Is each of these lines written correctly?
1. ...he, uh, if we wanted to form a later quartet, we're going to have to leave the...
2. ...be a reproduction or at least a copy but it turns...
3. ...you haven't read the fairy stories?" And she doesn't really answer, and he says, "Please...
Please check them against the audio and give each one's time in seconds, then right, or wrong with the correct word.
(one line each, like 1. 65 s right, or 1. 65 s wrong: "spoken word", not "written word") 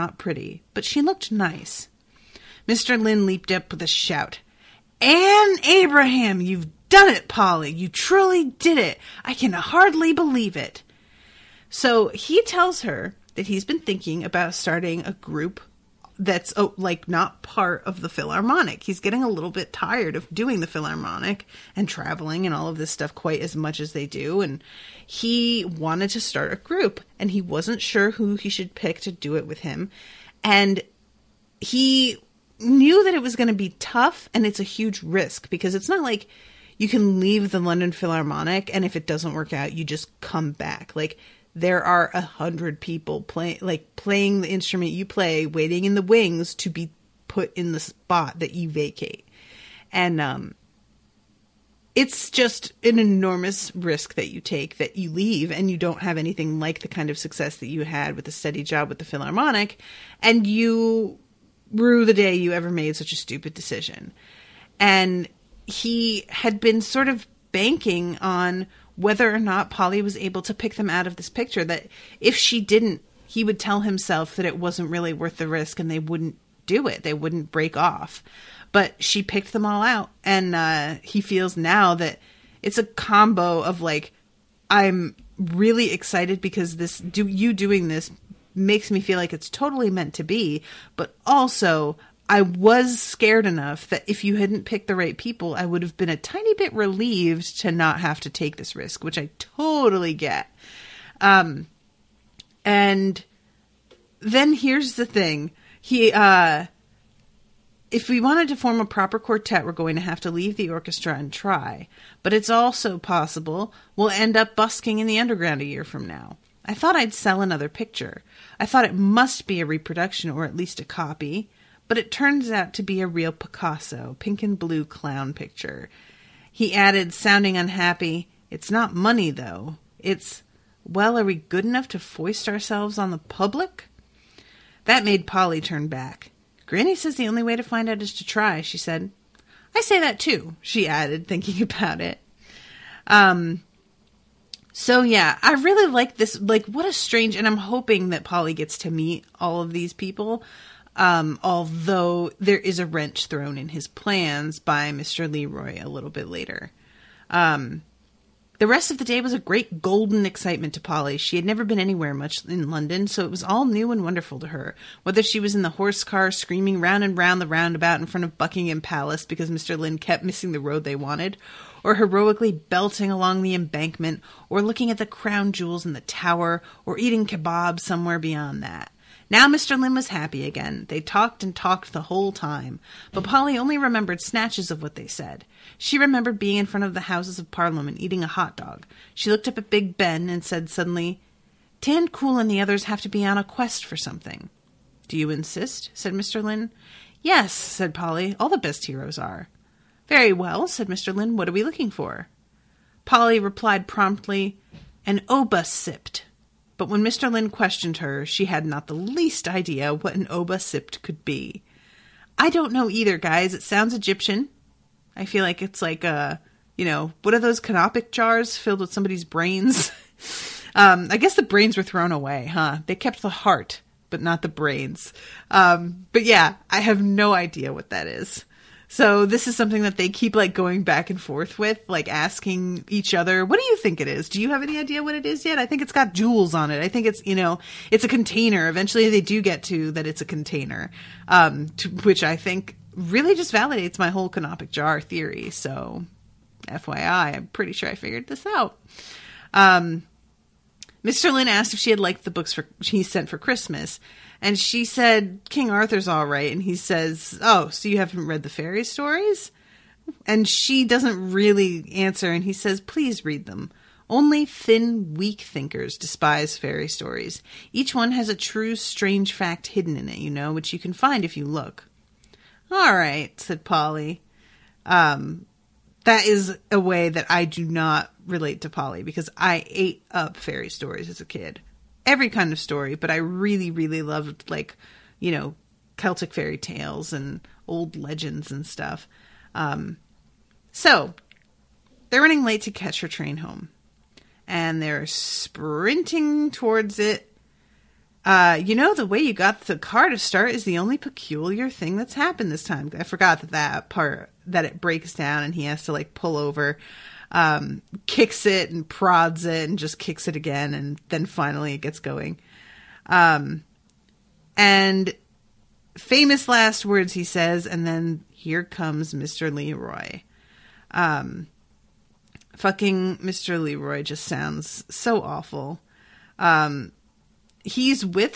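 1. 105 s wrong: "proper", not "later"
2. 119 s right
3. 257 s right.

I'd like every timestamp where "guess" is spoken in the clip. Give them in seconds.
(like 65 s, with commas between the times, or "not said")
221 s.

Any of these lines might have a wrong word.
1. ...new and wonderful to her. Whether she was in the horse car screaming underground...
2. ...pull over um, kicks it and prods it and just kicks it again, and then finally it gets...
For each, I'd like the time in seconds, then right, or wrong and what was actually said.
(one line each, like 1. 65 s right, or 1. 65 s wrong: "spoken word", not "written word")
1. 163 s wrong: "round", not "underground"
2. 306 s right.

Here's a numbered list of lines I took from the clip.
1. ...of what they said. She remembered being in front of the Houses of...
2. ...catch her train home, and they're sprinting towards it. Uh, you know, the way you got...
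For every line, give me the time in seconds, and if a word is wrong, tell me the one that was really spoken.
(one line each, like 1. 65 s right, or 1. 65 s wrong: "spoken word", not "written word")
1. 184 s right
2. 292 s right.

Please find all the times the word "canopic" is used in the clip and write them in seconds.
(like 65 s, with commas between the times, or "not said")
217 s, 244 s.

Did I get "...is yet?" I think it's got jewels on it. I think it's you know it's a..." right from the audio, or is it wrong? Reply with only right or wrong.
right.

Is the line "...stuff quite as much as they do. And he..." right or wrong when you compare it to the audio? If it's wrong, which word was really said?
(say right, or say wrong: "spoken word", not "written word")
right.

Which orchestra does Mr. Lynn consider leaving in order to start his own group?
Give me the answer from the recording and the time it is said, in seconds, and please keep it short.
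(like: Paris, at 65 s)
London Philharmonic, at 37 s.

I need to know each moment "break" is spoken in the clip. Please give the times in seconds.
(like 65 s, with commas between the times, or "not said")
77 s, 304 s.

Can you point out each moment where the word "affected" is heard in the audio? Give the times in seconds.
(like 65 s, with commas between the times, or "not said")
not said.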